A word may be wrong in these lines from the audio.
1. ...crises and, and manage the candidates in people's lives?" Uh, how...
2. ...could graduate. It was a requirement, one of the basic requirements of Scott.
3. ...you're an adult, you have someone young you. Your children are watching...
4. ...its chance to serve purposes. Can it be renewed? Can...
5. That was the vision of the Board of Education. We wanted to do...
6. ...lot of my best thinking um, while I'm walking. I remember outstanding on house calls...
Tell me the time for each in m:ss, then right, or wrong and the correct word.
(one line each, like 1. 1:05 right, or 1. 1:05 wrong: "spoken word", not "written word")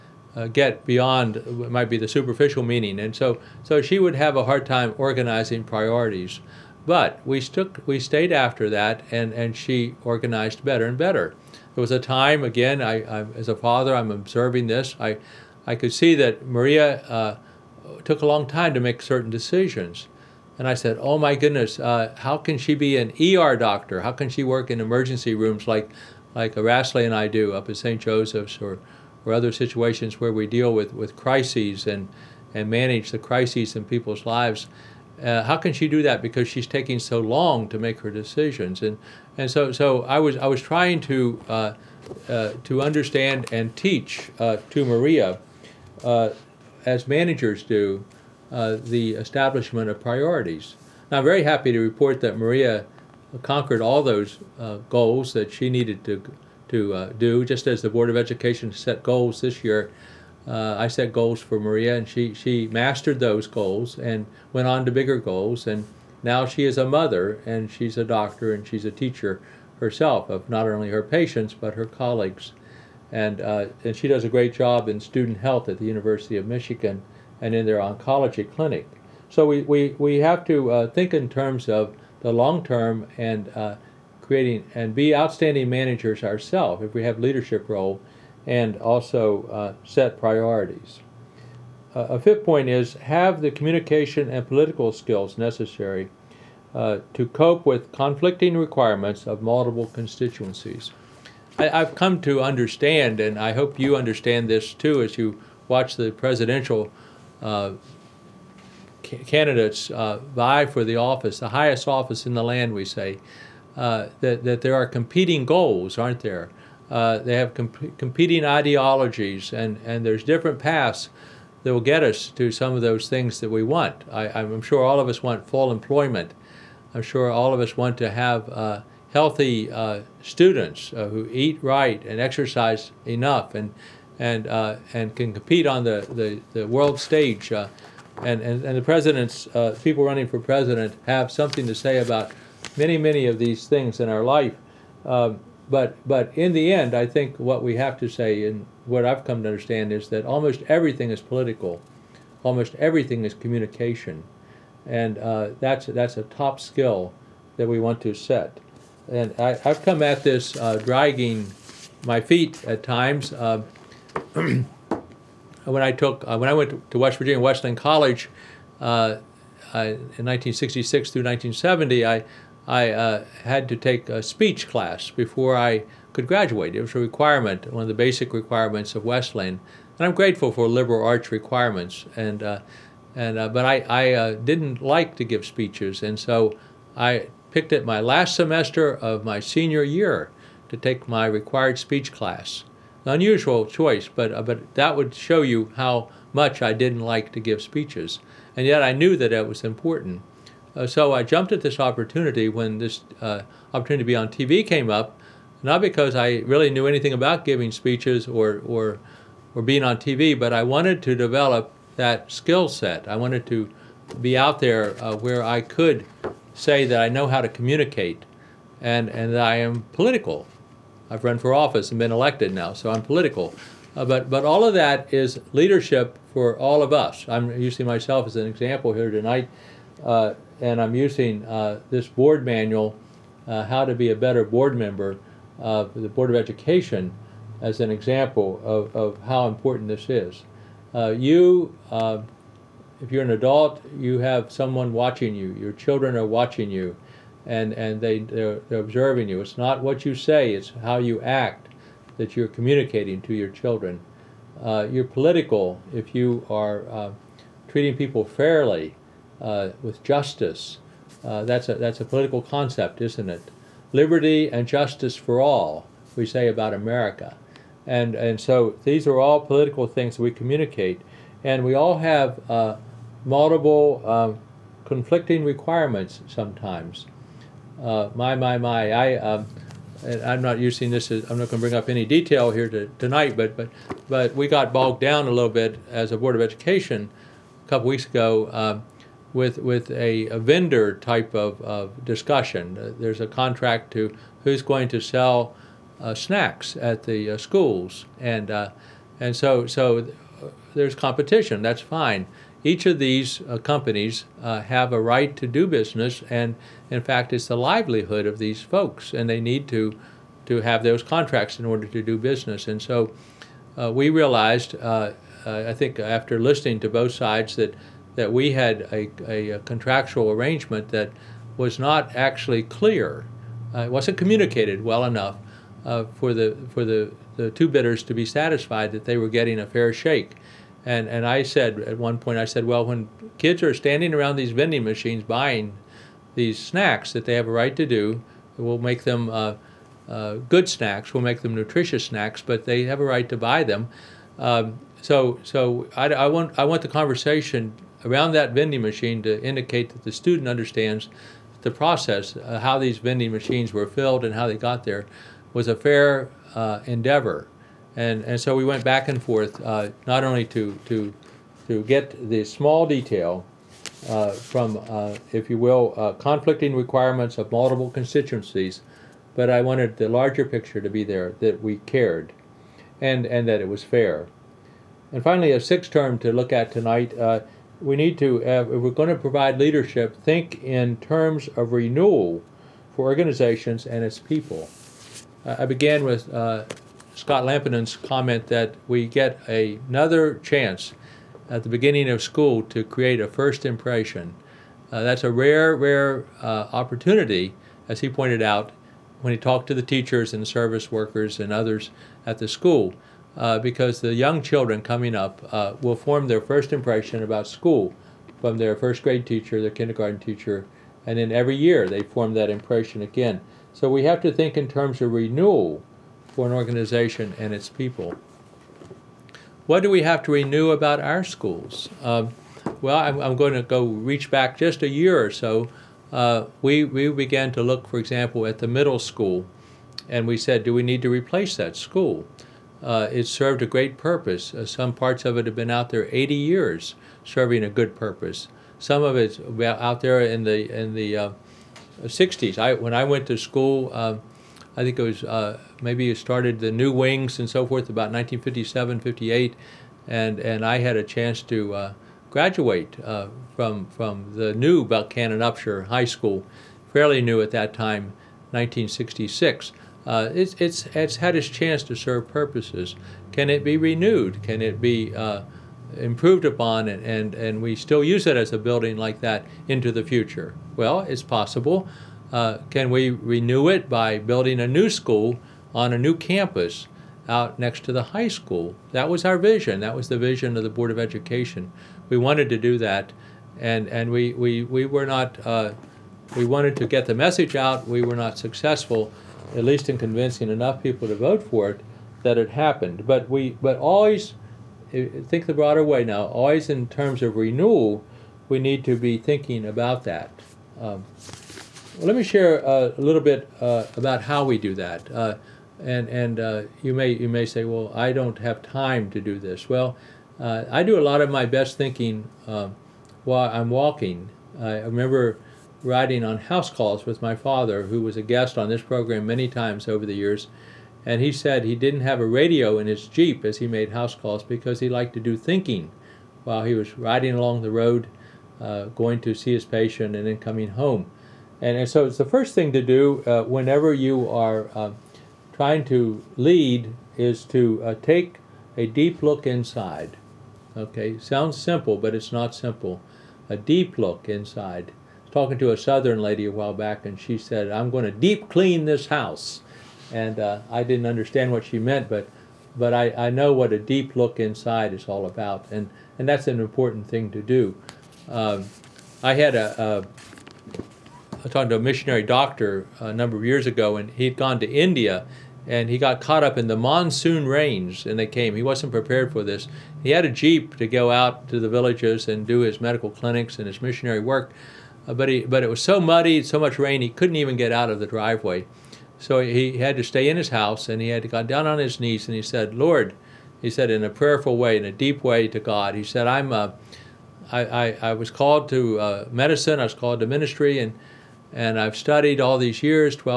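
1. 0:31 wrong: "crises", not "candidates"
2. 2:56 wrong: "Wesleyan", not "Scott"
3. 4:03 wrong: "watching", not "young"
4. 7:41 right
5. 7:59 right
6. 8:31 wrong: "riding", not "outstanding".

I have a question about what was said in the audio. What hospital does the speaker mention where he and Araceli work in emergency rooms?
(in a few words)
St. Joseph's.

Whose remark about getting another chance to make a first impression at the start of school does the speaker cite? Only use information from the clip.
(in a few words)
Scott Lampinen.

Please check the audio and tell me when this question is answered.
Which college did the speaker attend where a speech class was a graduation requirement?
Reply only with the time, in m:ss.
2:46.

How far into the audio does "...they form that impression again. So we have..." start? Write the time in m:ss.
6:51.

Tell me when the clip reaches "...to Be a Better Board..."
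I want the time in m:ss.
3:53.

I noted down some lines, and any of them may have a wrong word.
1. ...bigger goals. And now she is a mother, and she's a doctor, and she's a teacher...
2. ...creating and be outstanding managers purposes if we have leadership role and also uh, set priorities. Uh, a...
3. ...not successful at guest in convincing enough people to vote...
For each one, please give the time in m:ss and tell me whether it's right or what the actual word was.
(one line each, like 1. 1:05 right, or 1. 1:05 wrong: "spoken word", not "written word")
1. 1:04 right
2. 1:24 wrong: "ourselves", not "purposes"
3. 8:08 wrong: "least", not "guest".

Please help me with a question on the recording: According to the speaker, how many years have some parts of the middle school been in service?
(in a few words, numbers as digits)
80 years.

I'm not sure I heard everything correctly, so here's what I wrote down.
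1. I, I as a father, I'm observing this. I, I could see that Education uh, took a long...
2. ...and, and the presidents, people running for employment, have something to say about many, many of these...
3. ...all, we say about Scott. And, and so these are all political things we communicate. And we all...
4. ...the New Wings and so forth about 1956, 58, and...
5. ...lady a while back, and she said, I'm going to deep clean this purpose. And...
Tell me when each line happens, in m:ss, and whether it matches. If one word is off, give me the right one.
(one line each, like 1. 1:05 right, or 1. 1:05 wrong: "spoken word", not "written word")
1. 0:12 wrong: "Maria", not "Education"
2. 2:18 wrong: "president", not "employment"
3. 4:25 wrong: "America", not "Scott"
4. 7:26 wrong: "1957", not "1956"
5. 9:06 wrong: "house", not "purpose".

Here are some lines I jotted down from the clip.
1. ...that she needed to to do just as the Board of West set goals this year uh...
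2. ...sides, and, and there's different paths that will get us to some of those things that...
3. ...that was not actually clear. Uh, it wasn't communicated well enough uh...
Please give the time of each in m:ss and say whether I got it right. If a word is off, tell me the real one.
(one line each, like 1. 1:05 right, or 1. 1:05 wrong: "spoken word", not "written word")
1. 0:55 wrong: "Education", not "West"
2. 1:58 wrong: "ideologies", not "sides"
3. 5:20 right.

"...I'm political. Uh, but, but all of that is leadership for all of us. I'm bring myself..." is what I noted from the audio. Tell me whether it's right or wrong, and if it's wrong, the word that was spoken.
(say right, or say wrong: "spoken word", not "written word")
wrong: "using", not "bring".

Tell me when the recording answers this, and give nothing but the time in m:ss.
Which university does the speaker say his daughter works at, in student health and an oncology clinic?
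1:15.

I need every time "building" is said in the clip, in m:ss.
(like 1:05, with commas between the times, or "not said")
7:48, 7:54.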